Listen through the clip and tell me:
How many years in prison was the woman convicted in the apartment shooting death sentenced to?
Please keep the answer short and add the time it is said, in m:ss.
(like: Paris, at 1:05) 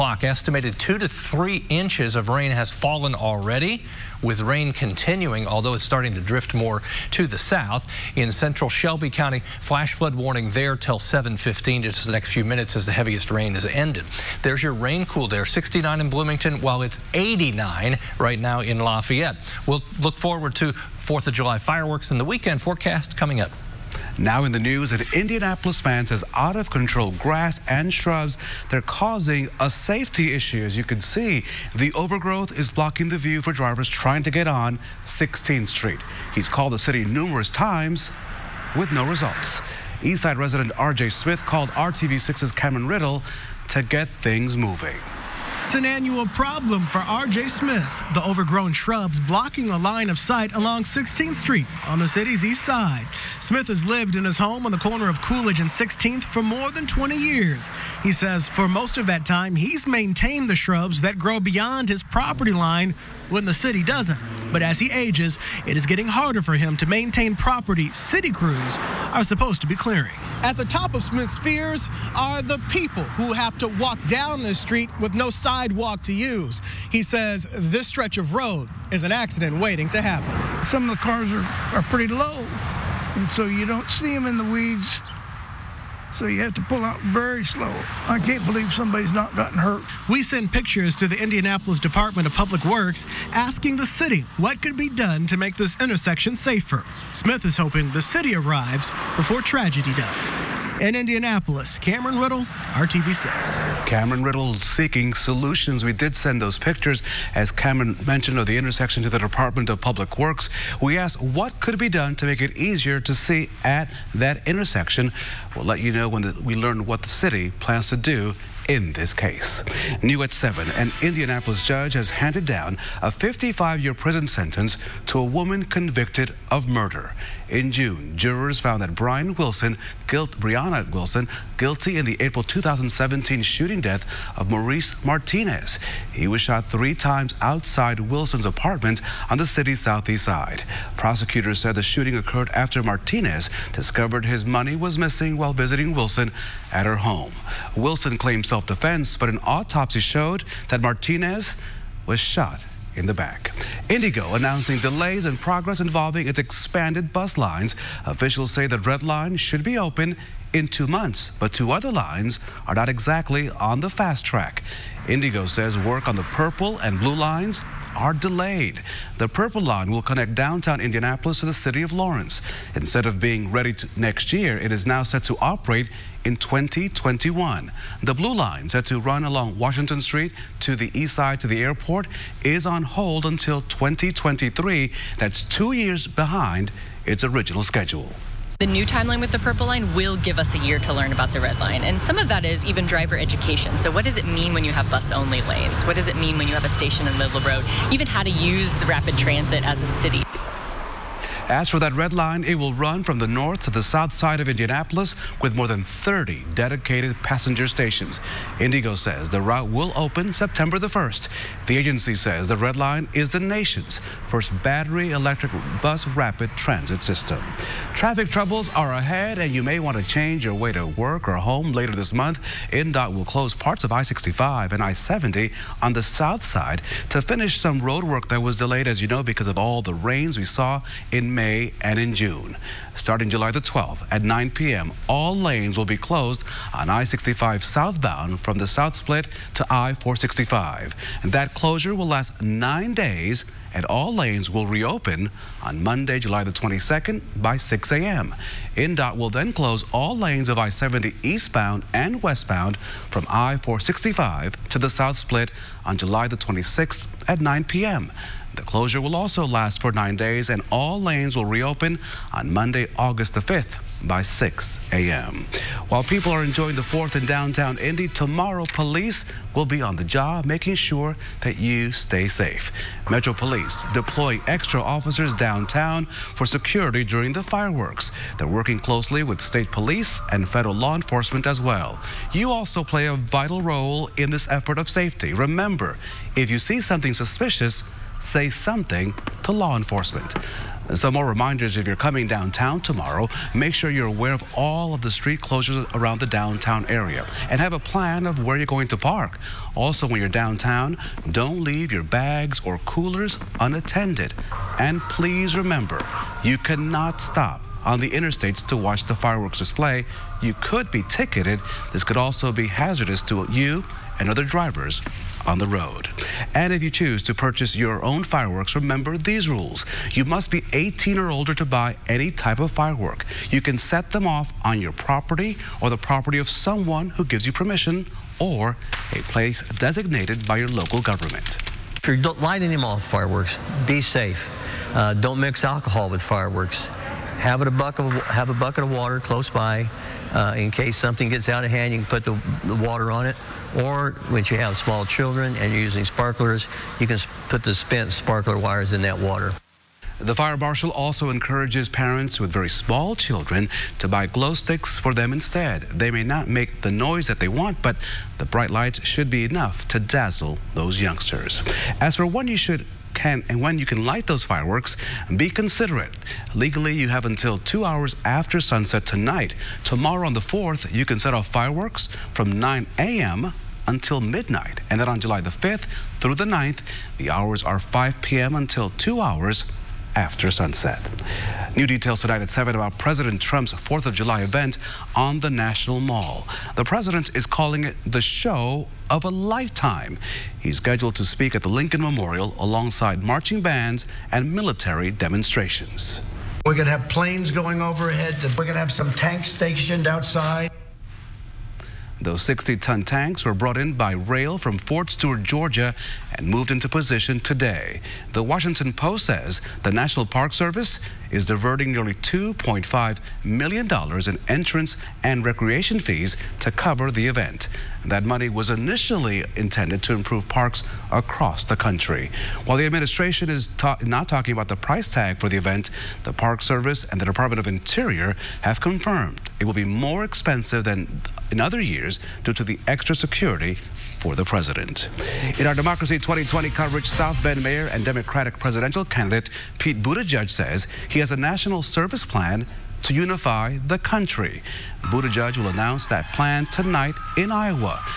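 55, at 2:03.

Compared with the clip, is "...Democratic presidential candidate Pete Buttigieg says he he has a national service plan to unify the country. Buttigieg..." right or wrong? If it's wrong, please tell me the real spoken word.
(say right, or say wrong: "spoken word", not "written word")
right.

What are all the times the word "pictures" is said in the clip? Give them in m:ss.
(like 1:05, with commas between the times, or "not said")
1:30, 1:46.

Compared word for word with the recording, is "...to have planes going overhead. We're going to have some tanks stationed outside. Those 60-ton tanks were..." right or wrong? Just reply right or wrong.
right.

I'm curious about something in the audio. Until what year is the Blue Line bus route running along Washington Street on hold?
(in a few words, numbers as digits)
2023.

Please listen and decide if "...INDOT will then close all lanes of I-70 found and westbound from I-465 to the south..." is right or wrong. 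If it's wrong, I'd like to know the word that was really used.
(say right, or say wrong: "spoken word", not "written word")
wrong: "eastbound", not "found".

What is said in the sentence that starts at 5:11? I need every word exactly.
This could also be hazardous to you and other drivers on the road.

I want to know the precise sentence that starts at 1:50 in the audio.
We asked what could be done to make it easier to see at that intersection.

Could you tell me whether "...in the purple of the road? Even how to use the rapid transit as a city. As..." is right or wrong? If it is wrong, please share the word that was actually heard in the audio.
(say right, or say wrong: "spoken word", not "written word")
wrong: "middle", not "purple".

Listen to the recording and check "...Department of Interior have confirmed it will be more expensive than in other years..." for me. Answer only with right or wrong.
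right.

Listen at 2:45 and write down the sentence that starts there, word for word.
IndyGo says work on the purple and blue lines are delayed.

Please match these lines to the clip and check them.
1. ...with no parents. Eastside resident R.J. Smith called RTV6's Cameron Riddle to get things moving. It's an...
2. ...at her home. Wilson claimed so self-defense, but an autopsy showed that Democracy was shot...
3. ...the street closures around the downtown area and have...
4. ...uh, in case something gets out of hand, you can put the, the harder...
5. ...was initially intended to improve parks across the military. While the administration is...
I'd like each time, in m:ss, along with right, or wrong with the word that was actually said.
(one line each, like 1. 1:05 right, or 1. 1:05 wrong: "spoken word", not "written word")
1. 0:38 wrong: "results", not "parents"
2. 2:26 wrong: "Martinez", not "Democracy"
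3. 4:55 right
4. 5:40 wrong: "water", not "harder"
5. 6:58 wrong: "country", not "military".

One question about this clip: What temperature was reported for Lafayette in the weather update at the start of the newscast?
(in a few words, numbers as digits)
89.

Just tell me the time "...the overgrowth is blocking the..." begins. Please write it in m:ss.
0:31.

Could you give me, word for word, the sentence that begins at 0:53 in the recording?
Smith has lived in his home on the corner of Coolidge and 16th for more than 20 years.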